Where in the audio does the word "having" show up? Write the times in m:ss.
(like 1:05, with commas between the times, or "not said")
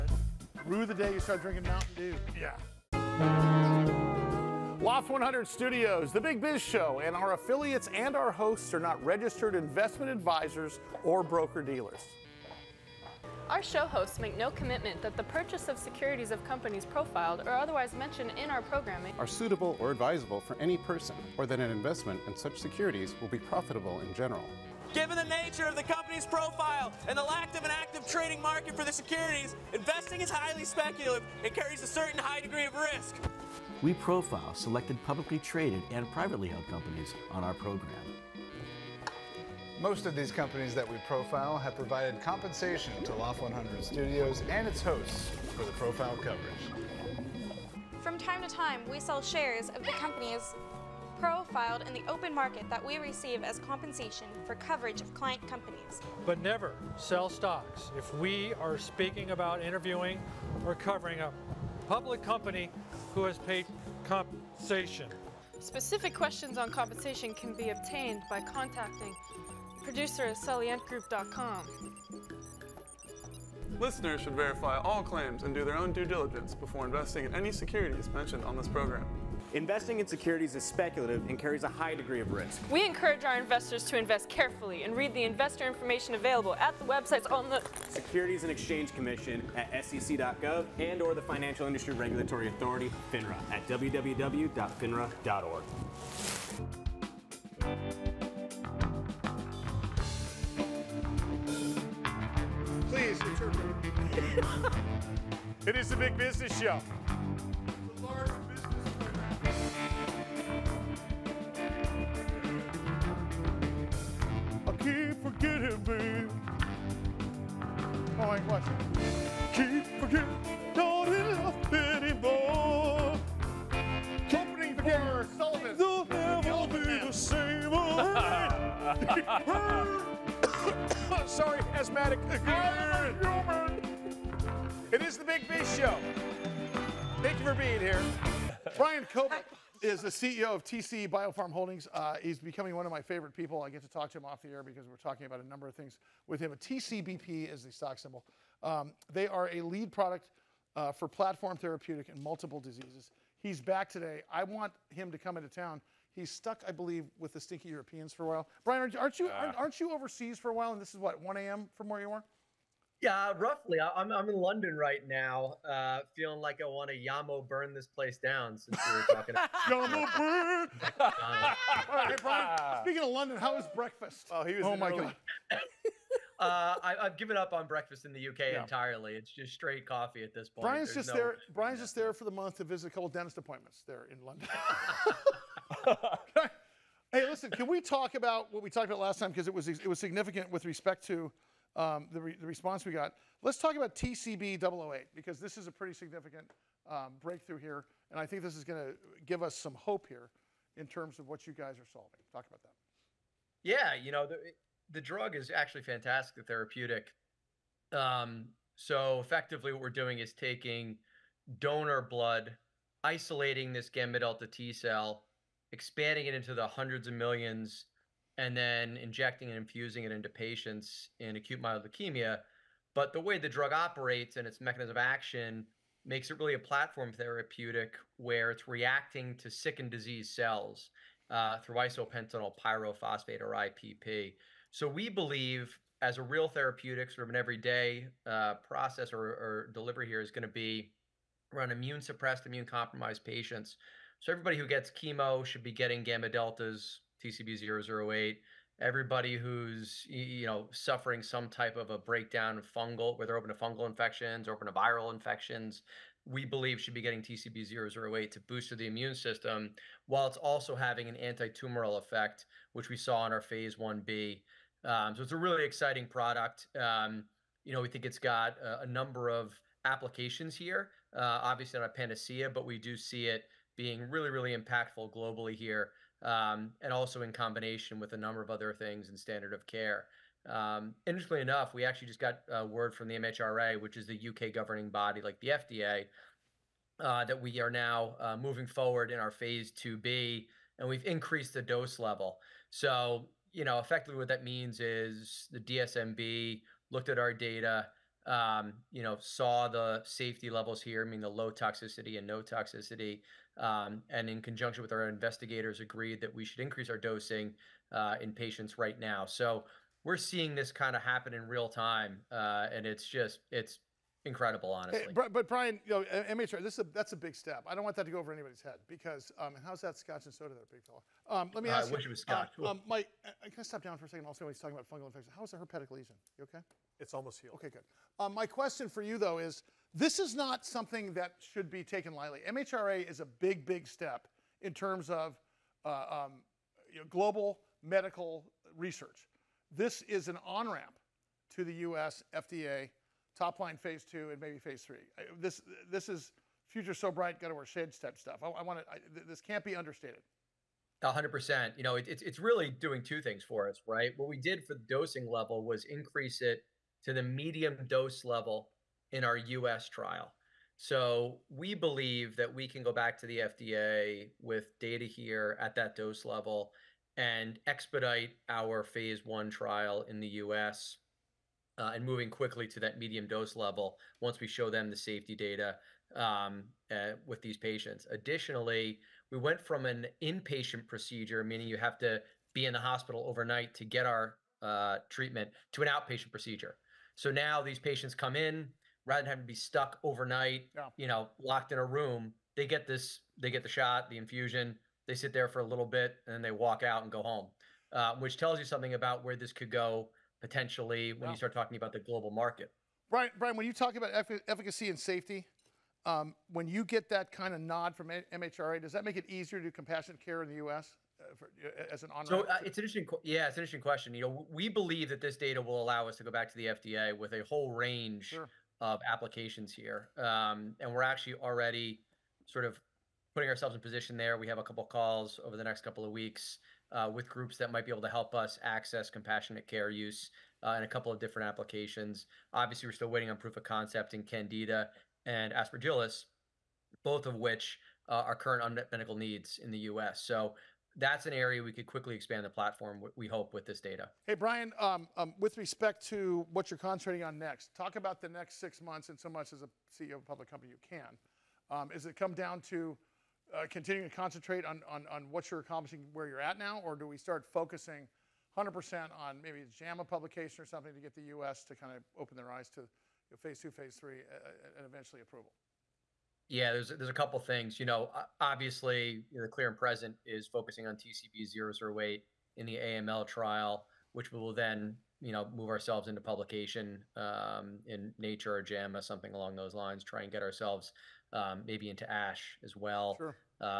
4:20, 6:29.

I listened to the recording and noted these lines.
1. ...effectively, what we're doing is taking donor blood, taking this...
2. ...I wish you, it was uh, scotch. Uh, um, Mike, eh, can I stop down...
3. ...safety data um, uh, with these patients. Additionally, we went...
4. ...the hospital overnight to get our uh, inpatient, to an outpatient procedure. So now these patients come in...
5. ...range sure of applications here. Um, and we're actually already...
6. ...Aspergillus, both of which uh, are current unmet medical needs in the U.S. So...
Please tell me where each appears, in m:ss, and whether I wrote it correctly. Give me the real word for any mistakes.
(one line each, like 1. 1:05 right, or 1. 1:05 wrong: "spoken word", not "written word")
1. 3:29 wrong: "isolating", not "taking"
2. 5:21 right
3. 6:14 right
4. 6:22 wrong: "treatment", not "inpatient"
5. 6:57 right
6. 7:15 right.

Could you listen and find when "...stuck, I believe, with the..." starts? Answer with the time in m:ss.
2:36.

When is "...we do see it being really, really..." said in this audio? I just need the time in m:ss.
4:32.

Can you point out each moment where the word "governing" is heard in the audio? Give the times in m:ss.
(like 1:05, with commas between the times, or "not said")
4:44.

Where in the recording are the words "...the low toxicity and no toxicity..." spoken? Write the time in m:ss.
5:01.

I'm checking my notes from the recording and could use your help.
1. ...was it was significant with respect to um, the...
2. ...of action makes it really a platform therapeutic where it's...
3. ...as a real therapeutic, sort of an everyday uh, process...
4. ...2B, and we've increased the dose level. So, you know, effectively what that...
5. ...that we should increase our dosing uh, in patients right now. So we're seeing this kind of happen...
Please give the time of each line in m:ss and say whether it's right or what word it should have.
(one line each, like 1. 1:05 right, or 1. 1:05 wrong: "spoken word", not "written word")
1. 3:09 right
2. 3:44 right
3. 3:55 right
4. 4:49 right
5. 5:06 right.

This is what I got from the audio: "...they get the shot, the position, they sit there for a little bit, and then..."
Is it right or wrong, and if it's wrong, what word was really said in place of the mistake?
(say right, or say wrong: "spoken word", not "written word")
wrong: "infusion", not "position".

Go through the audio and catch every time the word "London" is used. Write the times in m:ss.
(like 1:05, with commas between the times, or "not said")
2:44, 2:53, 3:04.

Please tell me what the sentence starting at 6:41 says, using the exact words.
you start talking about the global market.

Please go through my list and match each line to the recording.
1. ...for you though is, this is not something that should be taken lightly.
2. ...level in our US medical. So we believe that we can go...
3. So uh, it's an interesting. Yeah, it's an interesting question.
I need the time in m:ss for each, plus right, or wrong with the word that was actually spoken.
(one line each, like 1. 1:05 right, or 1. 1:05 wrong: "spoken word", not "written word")
1. 5:28 right
2. 5:58 wrong: "trial", not "medical"
3. 6:52 right.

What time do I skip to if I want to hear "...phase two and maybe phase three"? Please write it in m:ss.
5:43.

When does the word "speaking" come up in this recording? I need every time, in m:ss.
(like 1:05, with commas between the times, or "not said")
0:58, 2:52.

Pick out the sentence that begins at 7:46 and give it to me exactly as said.
Yeah, there's there's a couple things.